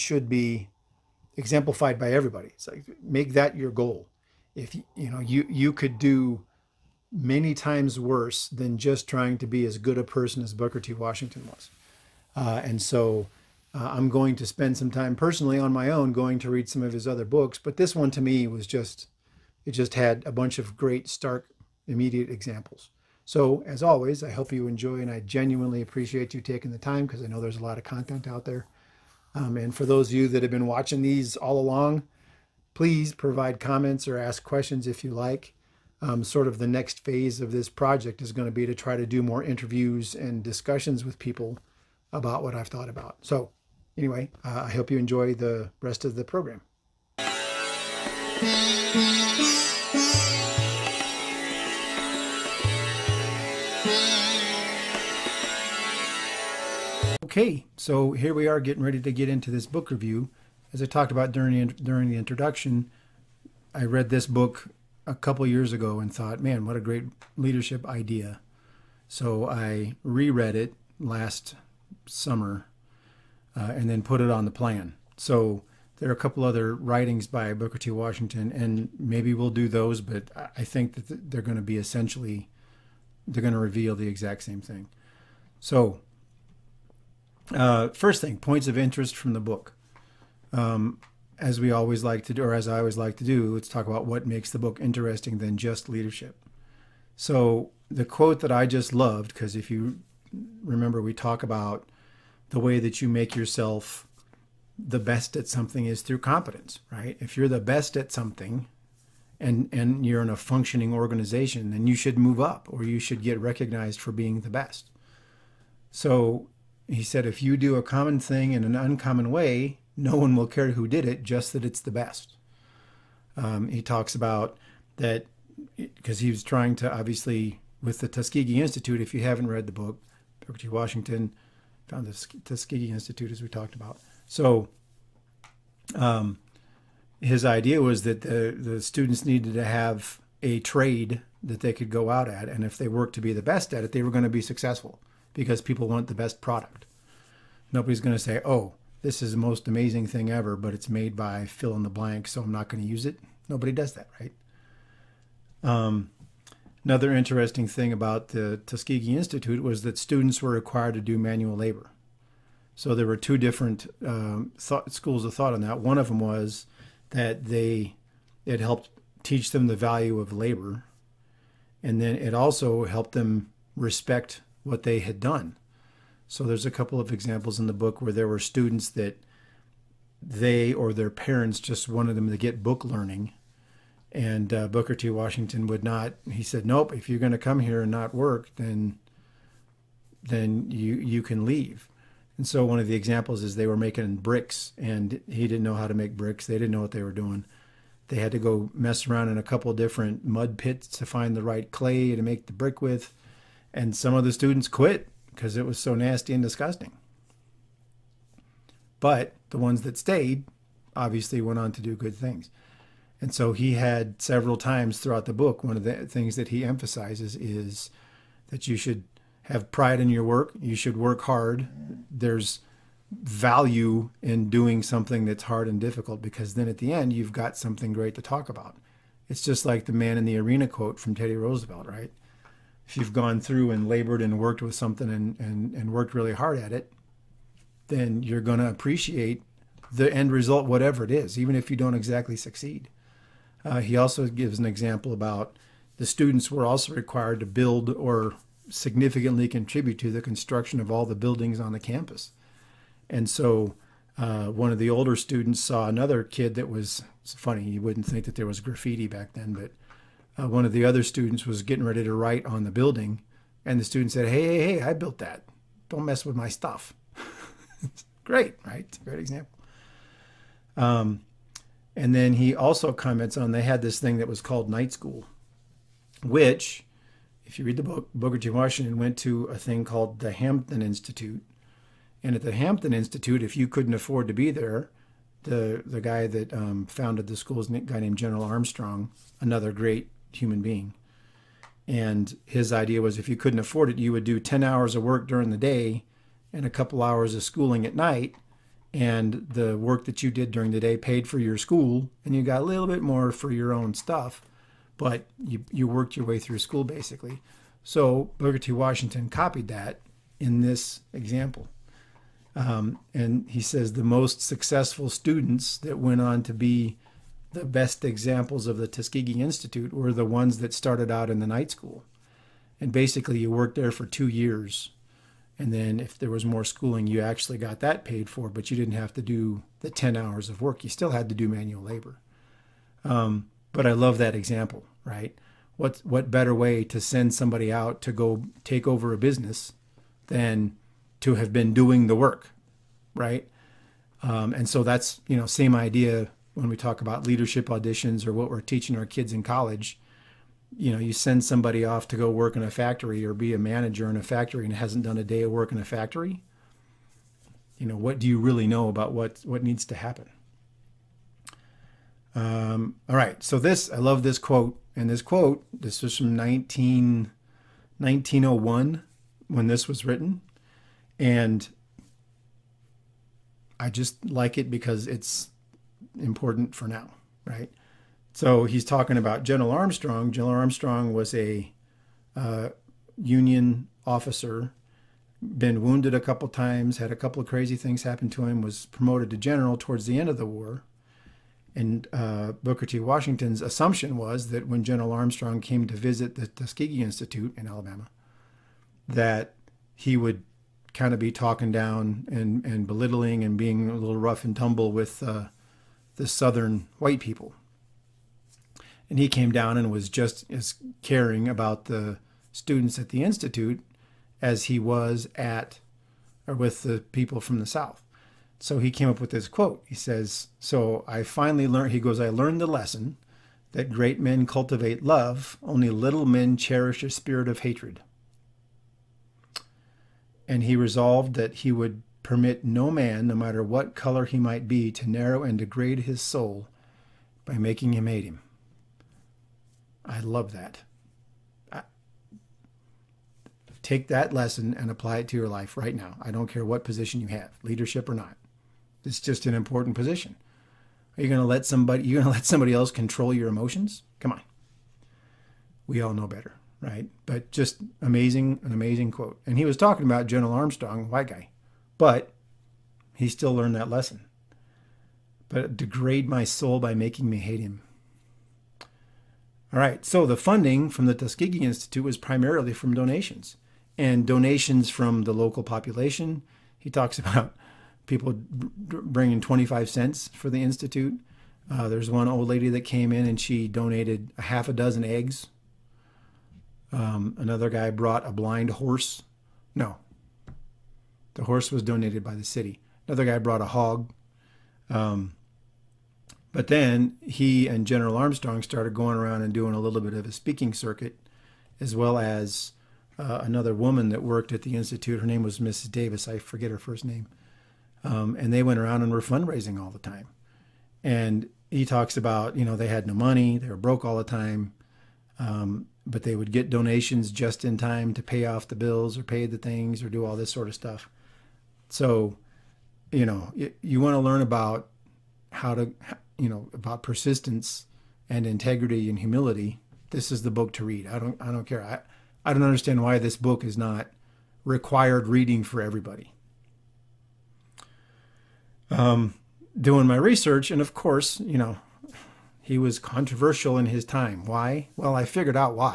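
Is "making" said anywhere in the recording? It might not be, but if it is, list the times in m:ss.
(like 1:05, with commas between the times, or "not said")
3:13, 7:17, 7:46.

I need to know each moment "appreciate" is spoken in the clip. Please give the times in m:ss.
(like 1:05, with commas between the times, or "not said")
0:25, 3:58.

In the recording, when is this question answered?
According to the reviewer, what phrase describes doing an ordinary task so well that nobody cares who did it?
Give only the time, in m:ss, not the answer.
1:57.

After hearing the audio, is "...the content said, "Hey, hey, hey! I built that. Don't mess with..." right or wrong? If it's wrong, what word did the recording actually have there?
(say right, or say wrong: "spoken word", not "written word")
wrong: "student", not "content".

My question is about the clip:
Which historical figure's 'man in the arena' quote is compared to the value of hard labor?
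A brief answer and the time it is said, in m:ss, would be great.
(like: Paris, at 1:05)
Teddy Roosevelt, at 3:51.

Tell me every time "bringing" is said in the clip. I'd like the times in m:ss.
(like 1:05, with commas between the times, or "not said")
7:58.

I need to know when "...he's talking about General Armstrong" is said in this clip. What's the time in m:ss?
6:18.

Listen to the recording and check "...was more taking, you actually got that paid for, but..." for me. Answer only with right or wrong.
wrong.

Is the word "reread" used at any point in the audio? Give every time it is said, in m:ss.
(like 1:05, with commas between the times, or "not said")
1:10.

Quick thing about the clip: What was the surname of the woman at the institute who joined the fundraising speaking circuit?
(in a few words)
Davis.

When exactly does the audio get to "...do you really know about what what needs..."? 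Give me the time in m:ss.
5:58.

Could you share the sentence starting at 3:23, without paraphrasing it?
And some of the students quit because it was so nasty and disgusting.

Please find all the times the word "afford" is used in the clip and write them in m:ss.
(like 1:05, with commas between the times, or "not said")
4:43, 4:53.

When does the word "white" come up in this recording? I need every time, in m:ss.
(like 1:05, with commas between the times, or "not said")
6:46, 7:41.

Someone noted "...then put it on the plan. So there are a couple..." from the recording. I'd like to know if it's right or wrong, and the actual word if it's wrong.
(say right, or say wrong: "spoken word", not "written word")
right.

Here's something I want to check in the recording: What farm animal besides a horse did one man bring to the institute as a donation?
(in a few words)
a hog.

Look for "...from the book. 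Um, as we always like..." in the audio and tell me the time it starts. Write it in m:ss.
1:29.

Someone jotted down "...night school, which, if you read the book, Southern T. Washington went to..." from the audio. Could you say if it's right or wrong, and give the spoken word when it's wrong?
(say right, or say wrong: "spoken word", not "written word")
wrong: "Booker", not "Southern".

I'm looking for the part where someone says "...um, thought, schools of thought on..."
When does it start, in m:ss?
2:44.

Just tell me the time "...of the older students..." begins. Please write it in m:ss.
4:14.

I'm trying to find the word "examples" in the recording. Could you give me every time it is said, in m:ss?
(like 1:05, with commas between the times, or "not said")
0:22, 2:57, 3:12, 4:04, 4:29, 5:11, 5:18, 5:34.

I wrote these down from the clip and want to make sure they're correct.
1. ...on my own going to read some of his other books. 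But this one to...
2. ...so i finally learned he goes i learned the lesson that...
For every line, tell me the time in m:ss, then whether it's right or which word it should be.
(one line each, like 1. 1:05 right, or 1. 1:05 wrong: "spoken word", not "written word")
1. 0:15 right
2. 7:00 right.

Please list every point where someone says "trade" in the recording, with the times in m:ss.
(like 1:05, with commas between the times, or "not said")
2:20.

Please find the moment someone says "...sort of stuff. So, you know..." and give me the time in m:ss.
8:40.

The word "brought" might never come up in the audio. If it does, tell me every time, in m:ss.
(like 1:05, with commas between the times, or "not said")
8:07, 8:13.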